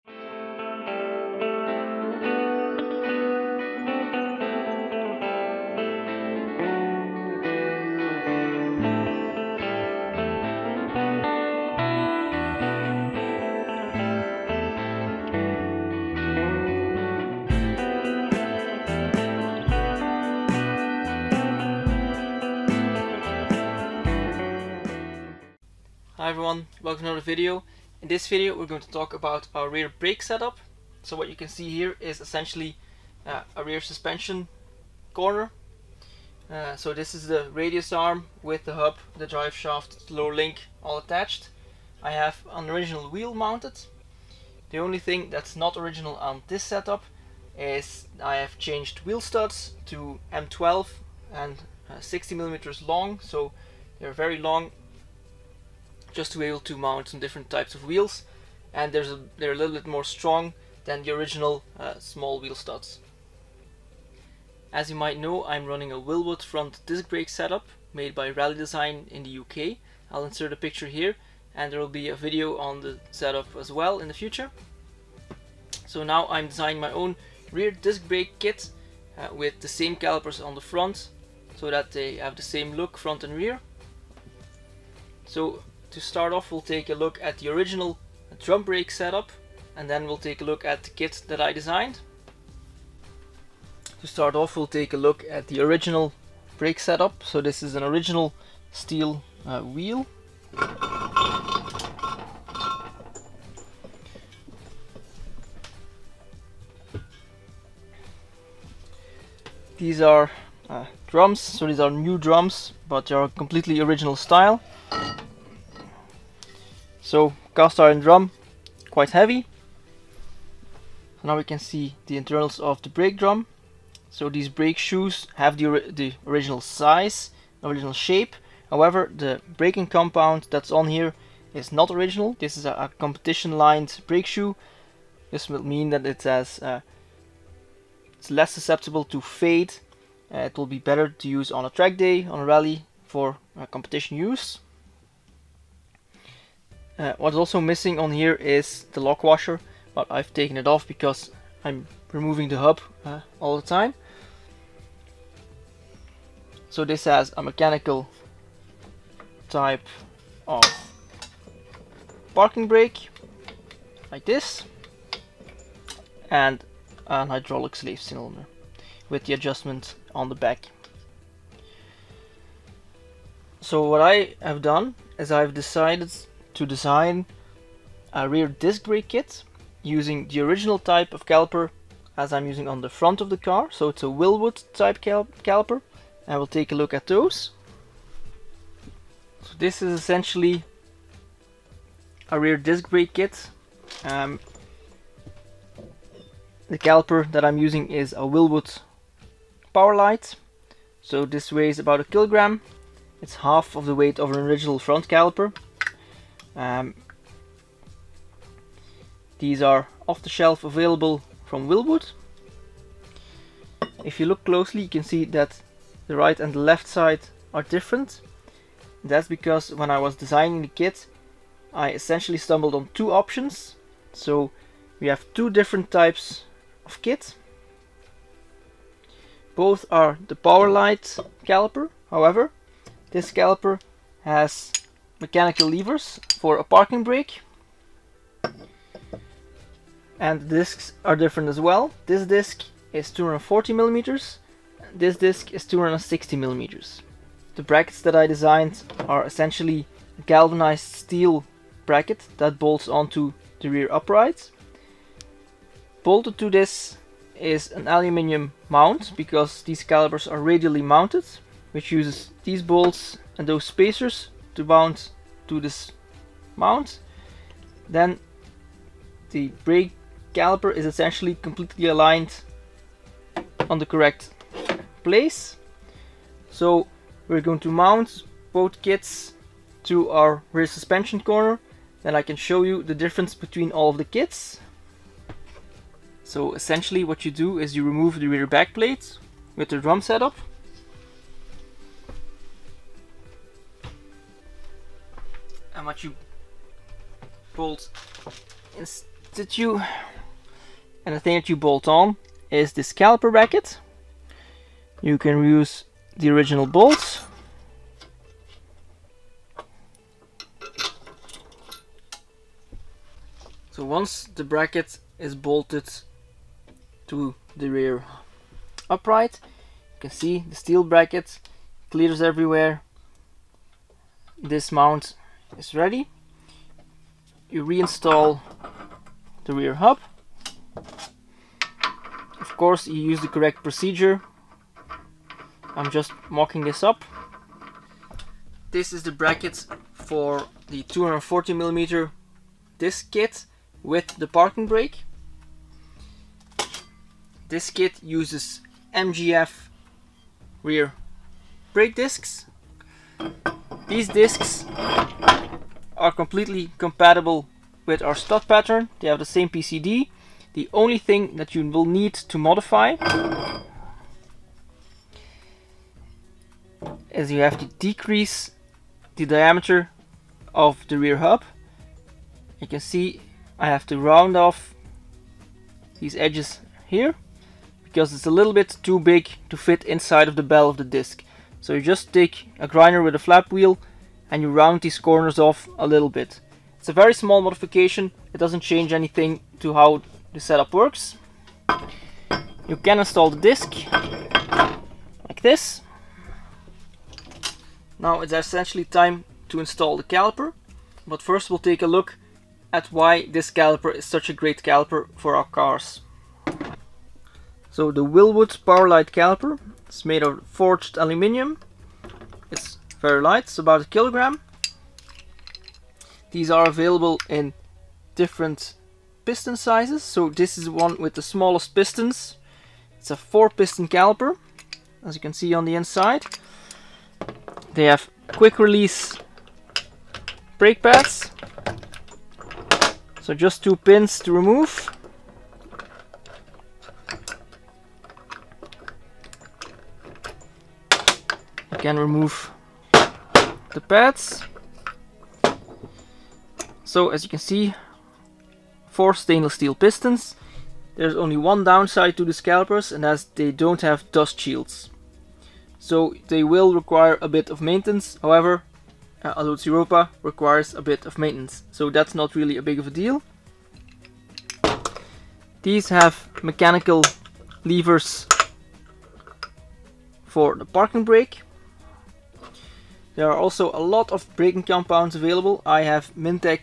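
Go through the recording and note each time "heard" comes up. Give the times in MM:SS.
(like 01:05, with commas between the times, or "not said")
not said.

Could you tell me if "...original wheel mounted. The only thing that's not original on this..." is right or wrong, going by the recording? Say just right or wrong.
right.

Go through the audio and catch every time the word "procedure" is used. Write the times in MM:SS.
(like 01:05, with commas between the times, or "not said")
05:33.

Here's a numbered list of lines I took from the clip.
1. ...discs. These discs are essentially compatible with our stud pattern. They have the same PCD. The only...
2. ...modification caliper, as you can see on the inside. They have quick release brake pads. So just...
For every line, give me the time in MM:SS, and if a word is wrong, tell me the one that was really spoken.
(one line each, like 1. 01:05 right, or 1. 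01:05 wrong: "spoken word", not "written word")
1. 05:51 wrong: "completely", not "essentially"
2. 07:03 wrong: "piston", not "modification".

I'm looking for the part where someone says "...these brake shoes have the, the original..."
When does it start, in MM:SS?
02:04.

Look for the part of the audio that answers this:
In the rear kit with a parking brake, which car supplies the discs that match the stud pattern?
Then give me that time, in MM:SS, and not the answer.
05:48.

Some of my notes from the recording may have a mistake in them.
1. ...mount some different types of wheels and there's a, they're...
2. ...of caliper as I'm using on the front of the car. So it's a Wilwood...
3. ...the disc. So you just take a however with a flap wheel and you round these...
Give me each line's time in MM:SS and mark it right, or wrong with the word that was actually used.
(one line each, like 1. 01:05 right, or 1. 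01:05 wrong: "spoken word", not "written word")
1. 00:56 right
2. 03:01 right
3. 06:20 wrong: "grinder", not "however".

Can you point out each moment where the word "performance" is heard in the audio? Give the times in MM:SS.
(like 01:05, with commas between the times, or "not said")
not said.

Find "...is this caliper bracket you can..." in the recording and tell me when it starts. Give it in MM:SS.
05:02.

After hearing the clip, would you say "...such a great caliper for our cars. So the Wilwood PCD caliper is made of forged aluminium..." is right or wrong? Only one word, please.
wrong.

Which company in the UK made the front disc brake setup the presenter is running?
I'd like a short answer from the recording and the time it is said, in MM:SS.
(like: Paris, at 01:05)
Rally Design, at 01:08.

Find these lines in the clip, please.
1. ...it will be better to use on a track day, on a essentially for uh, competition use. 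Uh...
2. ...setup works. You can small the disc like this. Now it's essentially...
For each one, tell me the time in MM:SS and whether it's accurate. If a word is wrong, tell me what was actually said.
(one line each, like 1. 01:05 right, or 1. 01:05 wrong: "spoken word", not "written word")
1. 02:20 wrong: "rally", not "essentially"
2. 06:30 wrong: "install", not "small".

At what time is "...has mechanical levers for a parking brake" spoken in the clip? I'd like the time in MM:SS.
03:54.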